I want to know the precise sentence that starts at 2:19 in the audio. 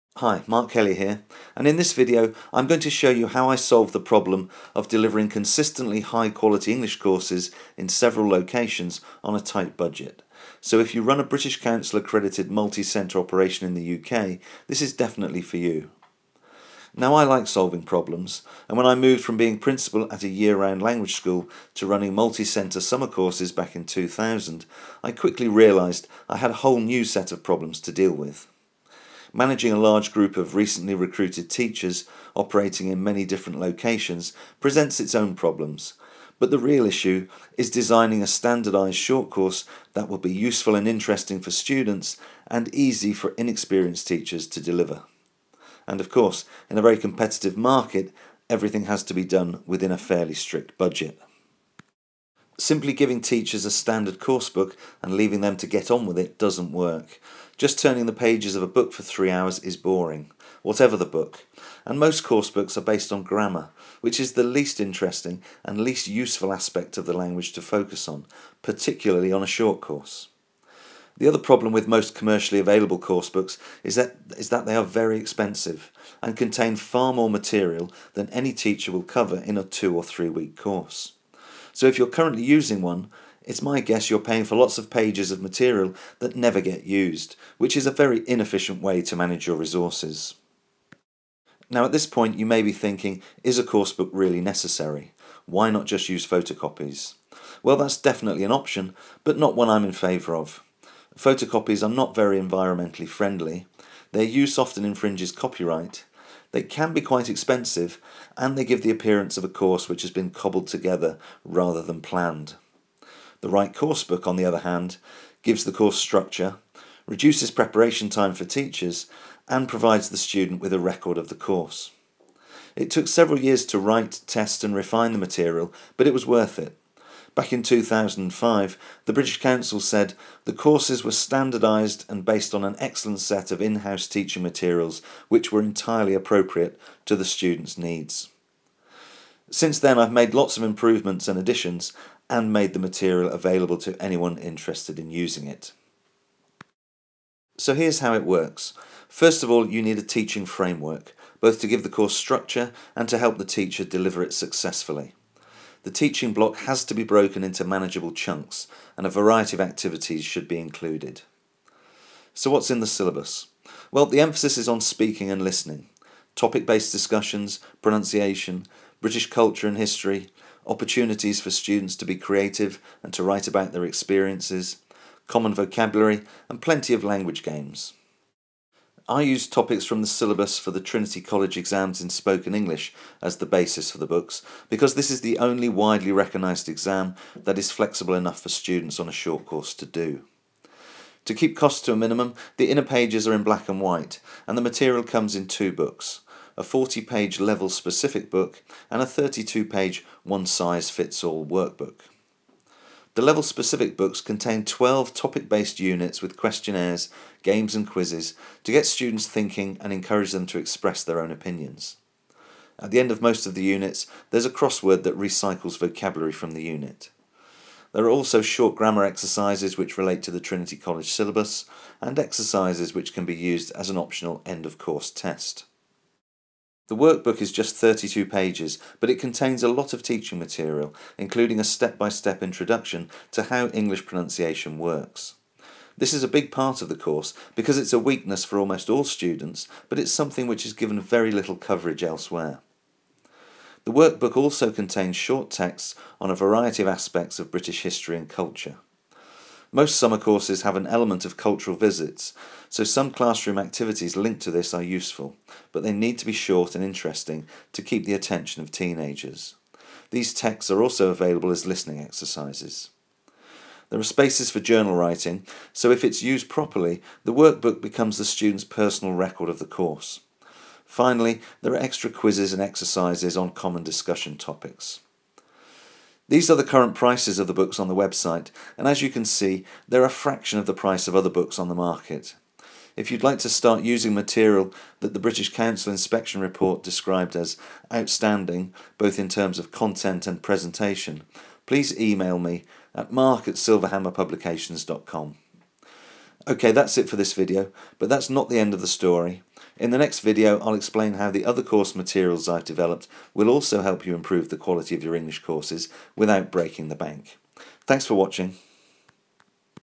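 Since then, I've made lots of improvements and additions, and made the material available to anyone interested in using it.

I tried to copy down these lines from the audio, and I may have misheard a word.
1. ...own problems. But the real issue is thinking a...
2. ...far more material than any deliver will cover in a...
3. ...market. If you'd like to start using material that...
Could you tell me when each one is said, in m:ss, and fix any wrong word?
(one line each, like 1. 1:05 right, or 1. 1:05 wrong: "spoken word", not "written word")
1. 0:35 wrong: "designing", not "thinking"
2. 1:16 wrong: "teacher", not "deliver"
3. 4:41 right.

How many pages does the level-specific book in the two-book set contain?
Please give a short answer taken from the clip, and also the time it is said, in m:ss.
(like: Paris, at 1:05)
40, at 3:16.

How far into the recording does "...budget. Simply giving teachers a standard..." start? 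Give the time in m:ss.
0:50.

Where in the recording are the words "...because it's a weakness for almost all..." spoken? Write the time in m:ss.
3:57.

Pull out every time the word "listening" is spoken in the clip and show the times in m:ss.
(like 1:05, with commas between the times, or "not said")
2:45, 4:21.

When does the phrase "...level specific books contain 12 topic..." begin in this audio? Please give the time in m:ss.
3:23.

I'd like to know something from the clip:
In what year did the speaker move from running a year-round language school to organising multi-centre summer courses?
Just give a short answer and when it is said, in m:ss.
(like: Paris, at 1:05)
2000, at 0:23.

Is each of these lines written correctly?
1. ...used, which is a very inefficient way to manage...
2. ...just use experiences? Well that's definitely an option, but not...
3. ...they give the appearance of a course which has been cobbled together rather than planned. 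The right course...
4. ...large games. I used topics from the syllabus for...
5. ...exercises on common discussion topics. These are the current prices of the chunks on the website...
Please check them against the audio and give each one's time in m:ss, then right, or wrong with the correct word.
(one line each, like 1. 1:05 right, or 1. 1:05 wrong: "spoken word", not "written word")
1. 1:26 right
2. 1:35 wrong: "photocopies", not "experiences"
3. 1:48 right
4. 2:57 wrong: "language", not "large"
5. 4:32 wrong: "books", not "chunks".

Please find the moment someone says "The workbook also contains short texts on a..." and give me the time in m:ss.
4:03.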